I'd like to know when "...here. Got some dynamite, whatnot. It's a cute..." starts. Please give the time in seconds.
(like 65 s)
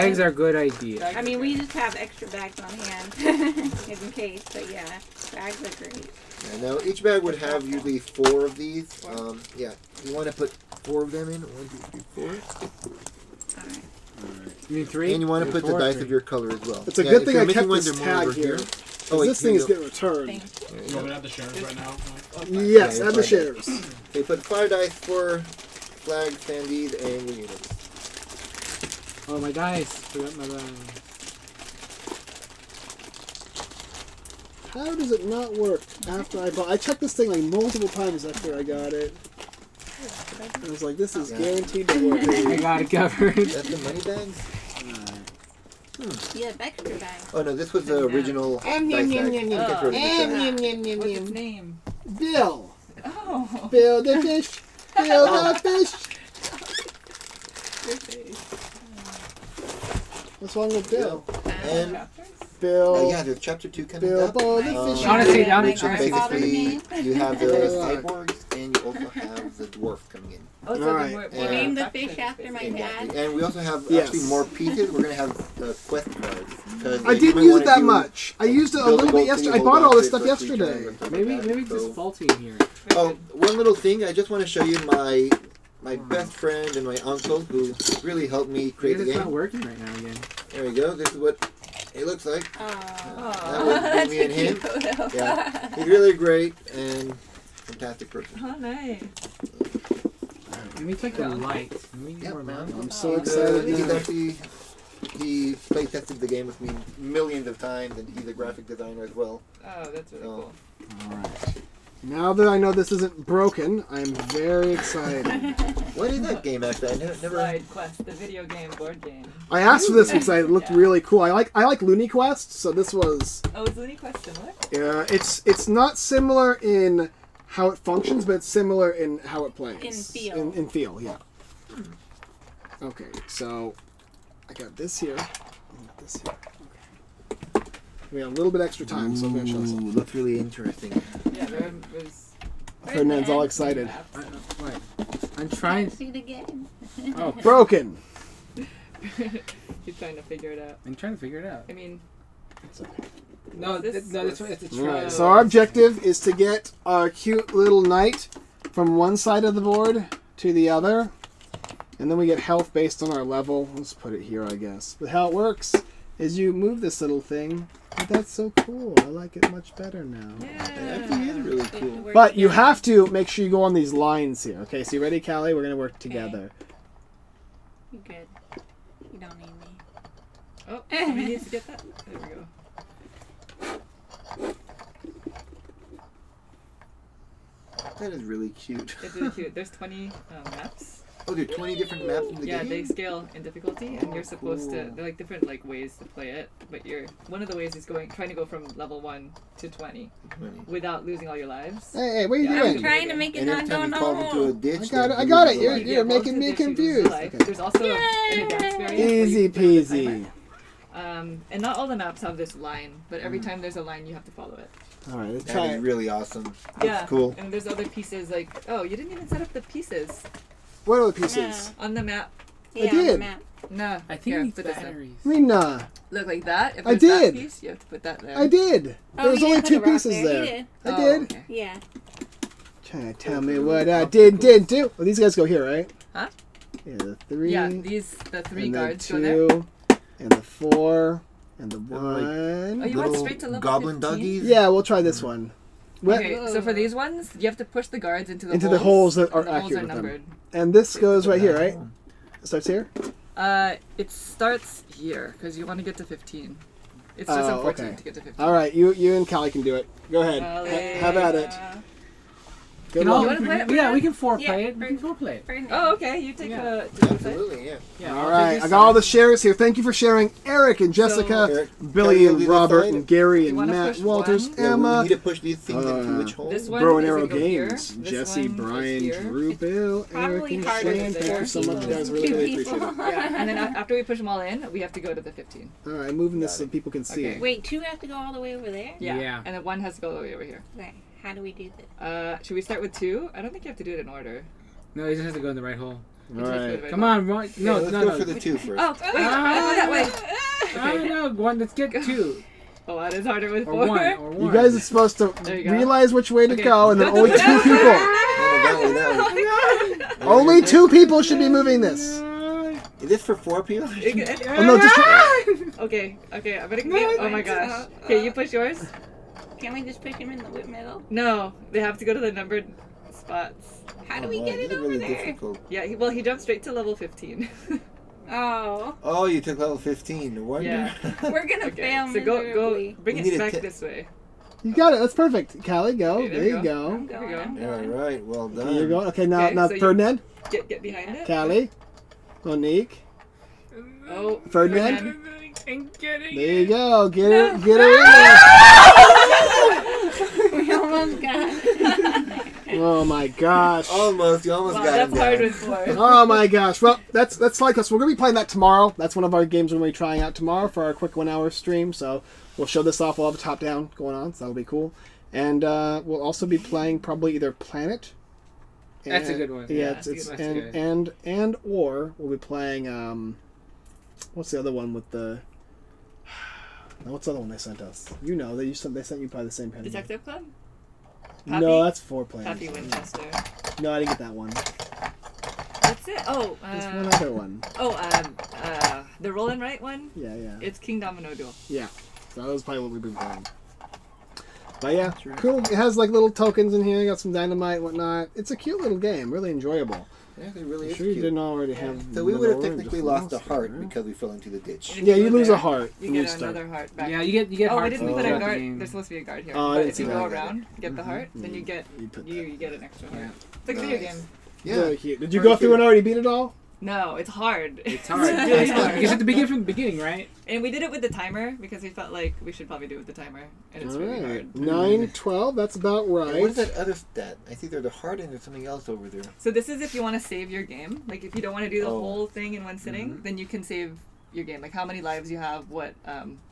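396 s.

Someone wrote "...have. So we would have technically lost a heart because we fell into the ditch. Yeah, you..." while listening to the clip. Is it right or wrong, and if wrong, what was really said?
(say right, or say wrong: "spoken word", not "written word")
right.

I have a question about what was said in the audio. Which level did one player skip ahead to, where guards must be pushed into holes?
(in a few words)
15.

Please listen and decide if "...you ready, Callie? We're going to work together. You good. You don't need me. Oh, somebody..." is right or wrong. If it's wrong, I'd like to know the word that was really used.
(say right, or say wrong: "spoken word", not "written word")
right.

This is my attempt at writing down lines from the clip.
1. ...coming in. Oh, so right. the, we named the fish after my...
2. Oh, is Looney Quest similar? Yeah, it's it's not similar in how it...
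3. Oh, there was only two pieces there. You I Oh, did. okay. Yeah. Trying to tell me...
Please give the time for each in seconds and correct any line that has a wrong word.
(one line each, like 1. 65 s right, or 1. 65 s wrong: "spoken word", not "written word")
1. 70 s right
2. 123 s right
3. 229 s right.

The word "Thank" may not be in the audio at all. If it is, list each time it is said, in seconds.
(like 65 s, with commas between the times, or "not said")
269 s, 281 s.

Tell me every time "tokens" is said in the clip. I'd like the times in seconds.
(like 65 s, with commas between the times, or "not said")
396 s.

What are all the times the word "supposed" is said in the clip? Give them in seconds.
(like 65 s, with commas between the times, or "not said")
194 s, 304 s, 408 s.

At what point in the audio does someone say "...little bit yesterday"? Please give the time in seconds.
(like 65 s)
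78 s.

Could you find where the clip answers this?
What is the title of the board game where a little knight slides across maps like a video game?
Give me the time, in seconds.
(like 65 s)
117 s.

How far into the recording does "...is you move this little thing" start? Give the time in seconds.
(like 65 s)
166 s.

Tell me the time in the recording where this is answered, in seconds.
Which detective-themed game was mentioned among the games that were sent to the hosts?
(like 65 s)
379 s.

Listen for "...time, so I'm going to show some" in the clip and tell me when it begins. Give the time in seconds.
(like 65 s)
138 s.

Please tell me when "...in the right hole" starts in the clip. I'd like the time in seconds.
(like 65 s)
295 s.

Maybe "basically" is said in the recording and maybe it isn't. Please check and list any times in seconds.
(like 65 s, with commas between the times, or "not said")
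65 s.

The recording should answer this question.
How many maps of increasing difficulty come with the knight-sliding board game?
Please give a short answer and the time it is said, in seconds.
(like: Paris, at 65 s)
20, at 189 s.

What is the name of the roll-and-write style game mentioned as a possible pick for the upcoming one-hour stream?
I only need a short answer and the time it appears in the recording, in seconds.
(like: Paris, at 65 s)
Kingdomino Duel, at 390 s.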